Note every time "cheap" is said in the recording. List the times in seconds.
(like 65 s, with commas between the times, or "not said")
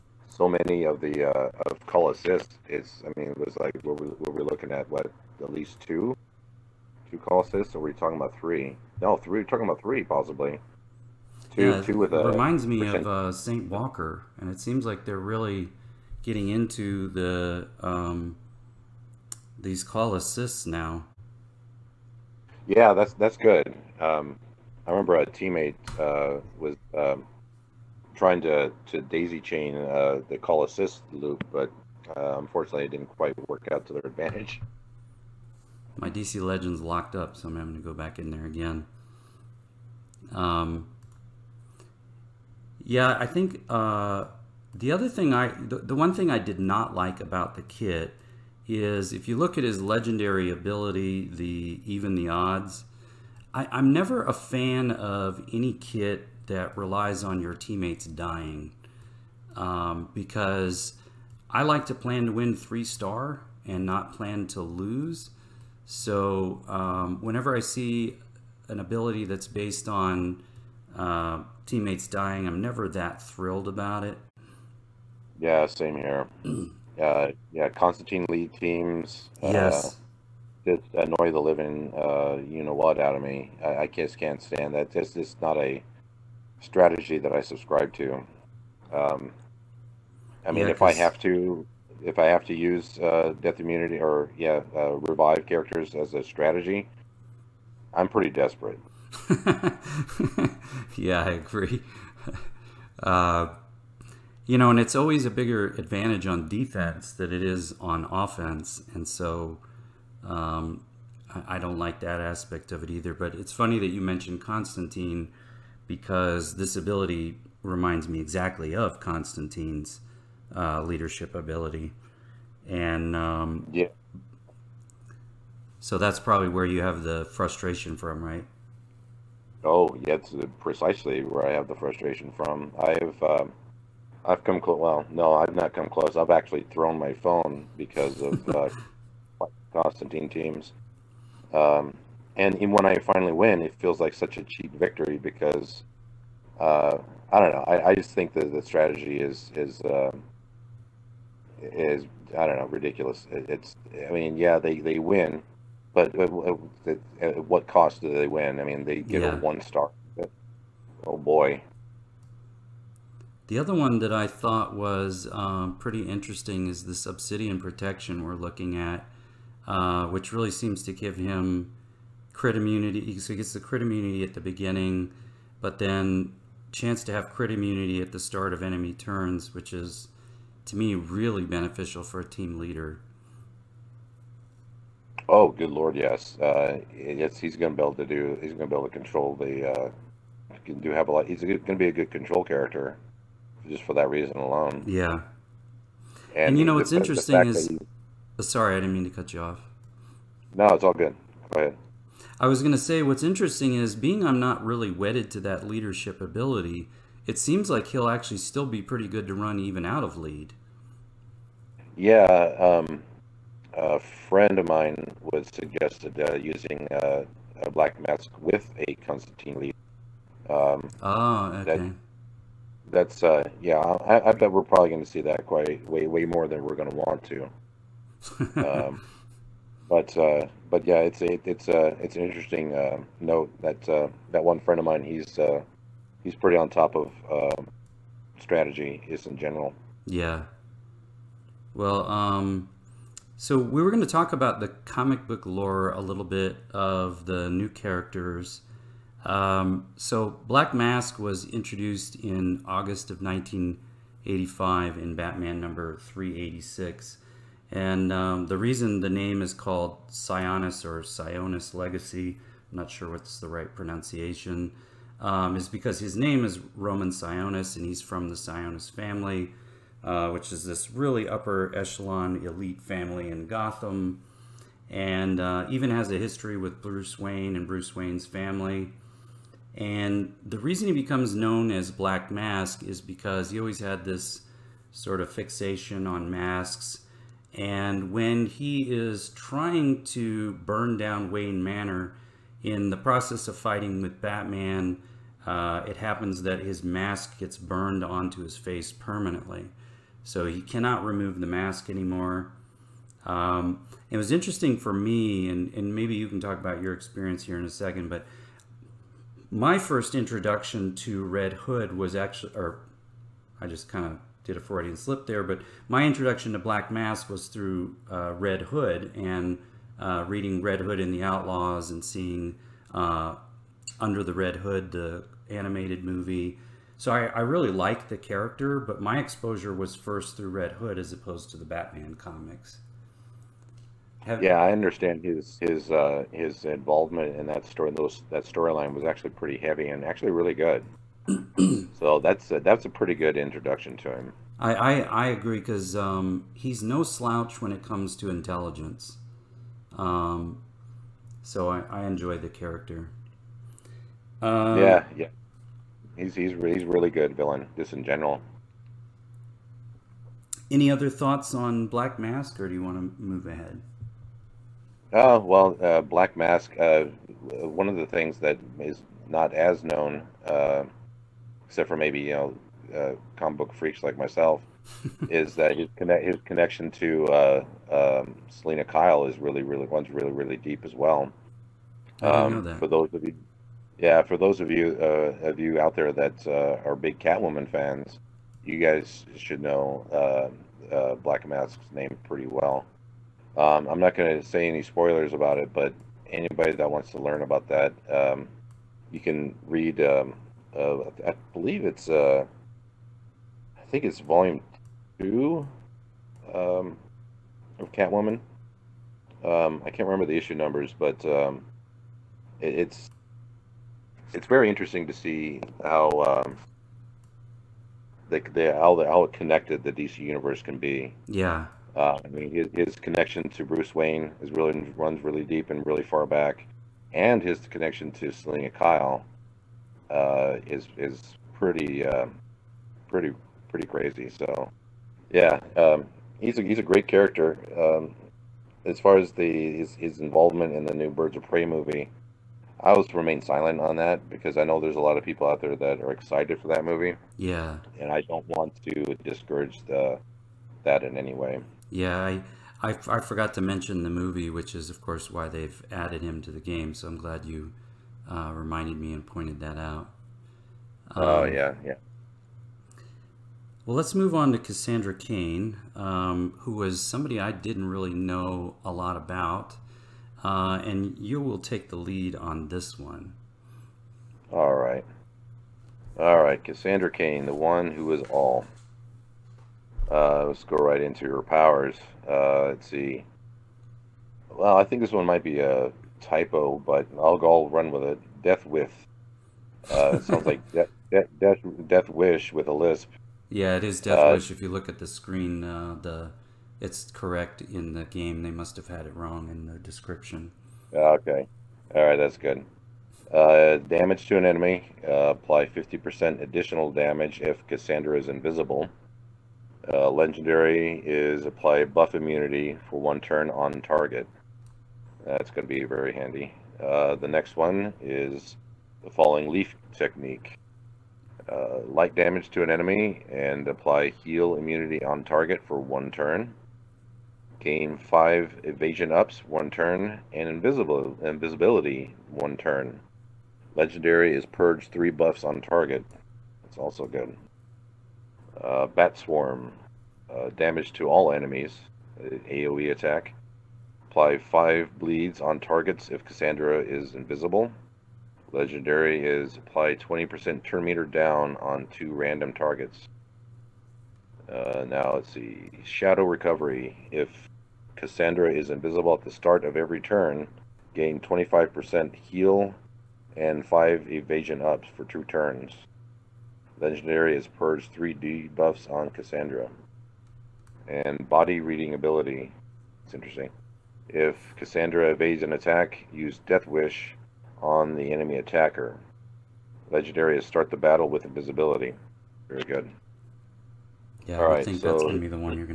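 144 s.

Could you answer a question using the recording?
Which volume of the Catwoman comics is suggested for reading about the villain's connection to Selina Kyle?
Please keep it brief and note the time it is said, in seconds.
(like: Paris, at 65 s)
Volume 2, at 404 s.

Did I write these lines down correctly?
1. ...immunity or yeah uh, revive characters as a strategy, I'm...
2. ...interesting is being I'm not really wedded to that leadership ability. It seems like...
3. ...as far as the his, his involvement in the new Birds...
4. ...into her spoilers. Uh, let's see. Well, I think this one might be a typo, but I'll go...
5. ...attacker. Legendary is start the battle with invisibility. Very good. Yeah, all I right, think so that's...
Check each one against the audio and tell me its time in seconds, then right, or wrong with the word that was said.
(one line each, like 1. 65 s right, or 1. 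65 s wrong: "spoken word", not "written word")
1. 93 s right
2. 203 s right
3. 438 s right
4. 481 s wrong: "powers", not "spoilers"
5. 578 s right.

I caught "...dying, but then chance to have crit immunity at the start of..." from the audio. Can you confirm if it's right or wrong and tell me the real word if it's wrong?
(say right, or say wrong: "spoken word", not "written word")
wrong: "beginning", not "dying".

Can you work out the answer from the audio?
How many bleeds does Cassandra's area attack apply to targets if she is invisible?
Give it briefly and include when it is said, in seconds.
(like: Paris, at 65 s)
5, at 544 s.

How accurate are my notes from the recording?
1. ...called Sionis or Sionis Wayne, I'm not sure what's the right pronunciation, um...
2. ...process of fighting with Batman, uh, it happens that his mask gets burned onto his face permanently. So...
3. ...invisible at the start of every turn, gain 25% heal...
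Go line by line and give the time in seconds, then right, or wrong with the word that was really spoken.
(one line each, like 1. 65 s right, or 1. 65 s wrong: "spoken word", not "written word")
1. 259 s wrong: "Legacy", not "Wayne"
2. 292 s right
3. 558 s right.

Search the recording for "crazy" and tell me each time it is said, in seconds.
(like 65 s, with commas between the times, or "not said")
433 s.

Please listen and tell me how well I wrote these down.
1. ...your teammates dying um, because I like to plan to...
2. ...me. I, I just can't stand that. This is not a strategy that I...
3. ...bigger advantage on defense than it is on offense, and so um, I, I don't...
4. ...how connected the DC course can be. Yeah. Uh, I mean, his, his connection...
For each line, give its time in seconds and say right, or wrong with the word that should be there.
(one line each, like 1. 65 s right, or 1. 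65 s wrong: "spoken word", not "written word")
1. 57 s right
2. 83 s right
3. 105 s right
4. 419 s wrong: "universe", not "course".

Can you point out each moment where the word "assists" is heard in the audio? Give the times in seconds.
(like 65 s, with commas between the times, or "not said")
2 s, 7 s, 20 s, 30 s.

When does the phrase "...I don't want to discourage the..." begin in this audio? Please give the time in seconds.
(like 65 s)
448 s.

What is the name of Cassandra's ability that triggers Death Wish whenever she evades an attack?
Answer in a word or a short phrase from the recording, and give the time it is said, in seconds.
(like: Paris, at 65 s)
Body reading, at 571 s.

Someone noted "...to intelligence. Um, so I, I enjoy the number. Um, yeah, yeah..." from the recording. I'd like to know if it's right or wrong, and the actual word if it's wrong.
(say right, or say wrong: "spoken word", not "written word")
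wrong: "character", not "number".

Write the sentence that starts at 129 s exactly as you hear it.
Oh, yeah, it's uh, precisely where I have the frustration from.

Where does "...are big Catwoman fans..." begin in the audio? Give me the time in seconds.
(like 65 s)
386 s.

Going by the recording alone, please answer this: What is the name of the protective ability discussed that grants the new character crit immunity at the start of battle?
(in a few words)
Obsidian protection.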